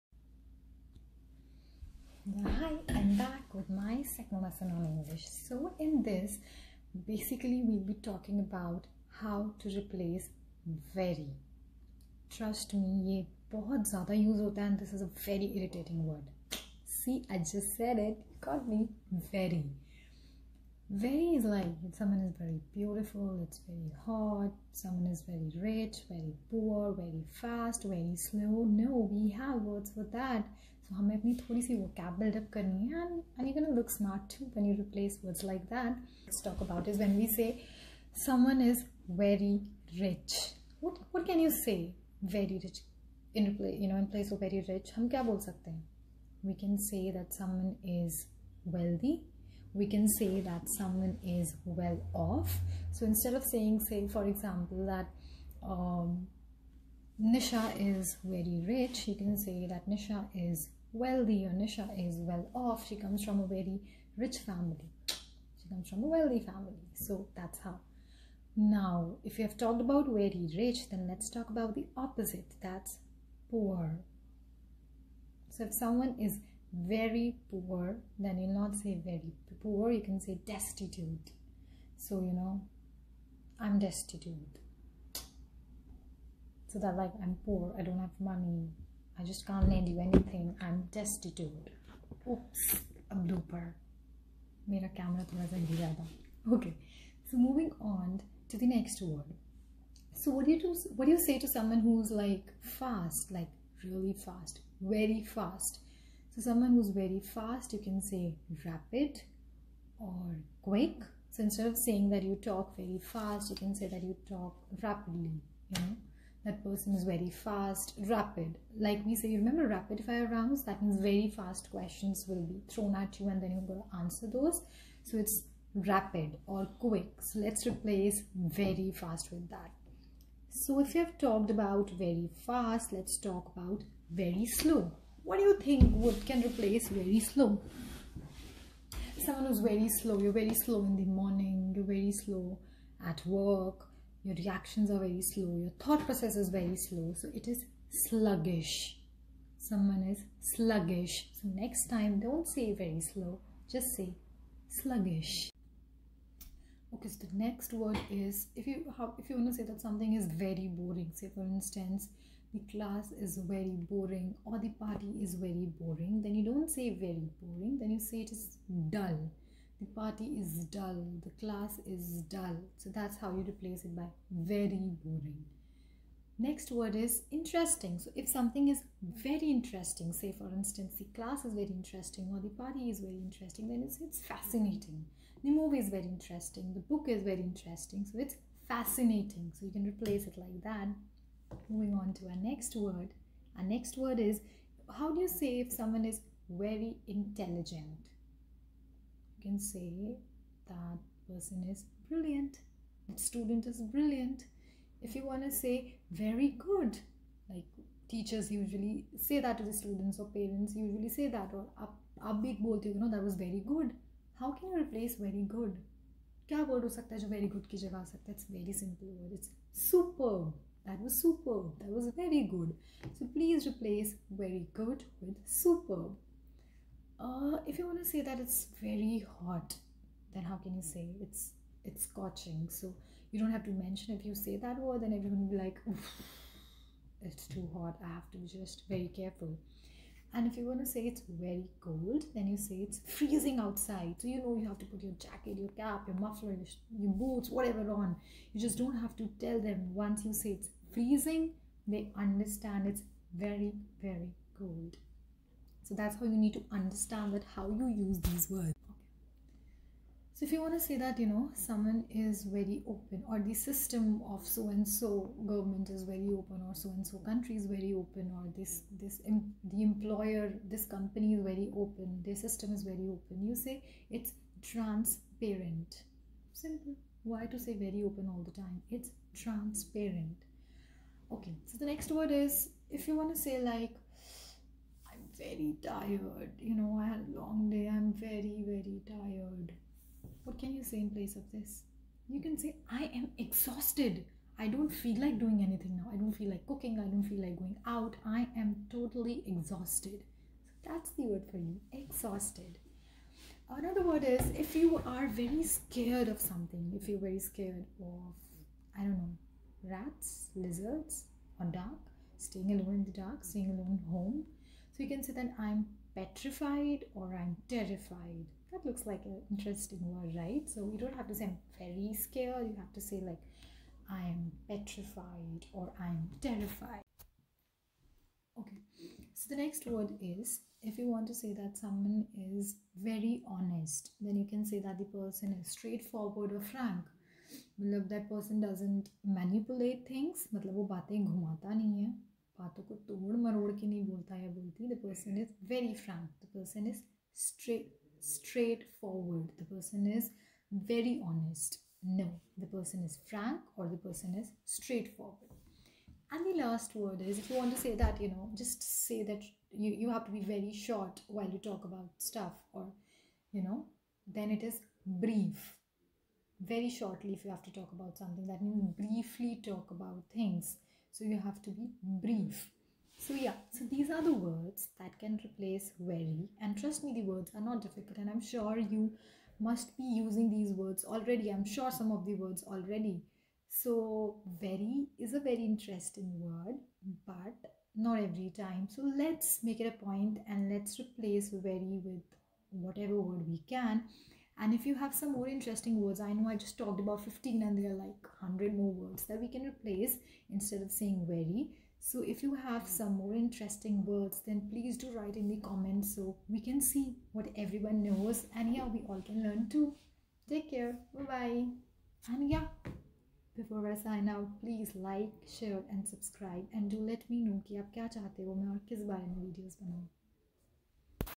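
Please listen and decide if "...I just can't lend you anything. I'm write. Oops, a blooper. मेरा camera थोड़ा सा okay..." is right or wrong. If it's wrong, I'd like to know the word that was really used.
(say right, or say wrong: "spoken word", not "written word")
wrong: "destitute", not "write".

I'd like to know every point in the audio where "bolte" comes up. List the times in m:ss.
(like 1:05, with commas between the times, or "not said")
3:32.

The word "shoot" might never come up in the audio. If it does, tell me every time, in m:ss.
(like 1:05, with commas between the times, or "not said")
not said.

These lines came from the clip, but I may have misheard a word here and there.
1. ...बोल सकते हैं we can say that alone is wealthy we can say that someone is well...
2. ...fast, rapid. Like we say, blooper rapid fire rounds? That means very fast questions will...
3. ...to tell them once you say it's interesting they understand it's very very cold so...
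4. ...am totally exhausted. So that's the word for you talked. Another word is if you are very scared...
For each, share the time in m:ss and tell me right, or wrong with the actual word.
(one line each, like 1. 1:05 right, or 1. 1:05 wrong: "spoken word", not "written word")
1. 0:45 wrong: "someone", not "alone"
2. 1:57 wrong: "remember", not "blooper"
3. 4:09 wrong: "freezing", not "interesting"
4. 4:58 wrong: "exhausted", not "talked".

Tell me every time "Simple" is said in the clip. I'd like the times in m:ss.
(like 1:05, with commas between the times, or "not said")
4:36.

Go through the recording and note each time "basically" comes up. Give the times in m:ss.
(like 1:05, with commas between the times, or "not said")
0:07.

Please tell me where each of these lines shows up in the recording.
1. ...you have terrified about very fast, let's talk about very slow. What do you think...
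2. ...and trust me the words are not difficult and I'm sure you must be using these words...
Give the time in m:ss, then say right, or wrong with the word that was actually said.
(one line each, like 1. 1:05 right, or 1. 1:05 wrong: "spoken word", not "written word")
1. 2:10 wrong: "talked", not "terrified"
2. 6:16 right.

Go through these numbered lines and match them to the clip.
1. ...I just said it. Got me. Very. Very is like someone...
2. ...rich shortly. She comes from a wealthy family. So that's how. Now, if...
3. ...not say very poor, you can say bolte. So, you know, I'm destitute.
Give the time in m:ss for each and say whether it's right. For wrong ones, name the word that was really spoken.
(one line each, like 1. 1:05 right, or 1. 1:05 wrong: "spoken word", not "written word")
1. 0:17 right
2. 1:04 wrong: "family", not "shortly"
3. 1:18 wrong: "destitute", not "bolte".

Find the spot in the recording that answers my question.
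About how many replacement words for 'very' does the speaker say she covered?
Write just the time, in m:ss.
6:37.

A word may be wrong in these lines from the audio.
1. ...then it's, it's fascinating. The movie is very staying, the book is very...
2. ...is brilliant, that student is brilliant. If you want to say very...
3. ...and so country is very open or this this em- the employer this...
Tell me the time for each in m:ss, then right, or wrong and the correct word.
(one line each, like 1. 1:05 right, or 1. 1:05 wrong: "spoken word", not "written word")
1. 3:03 wrong: "interesting", not "staying"
2. 3:21 right
3. 4:26 right.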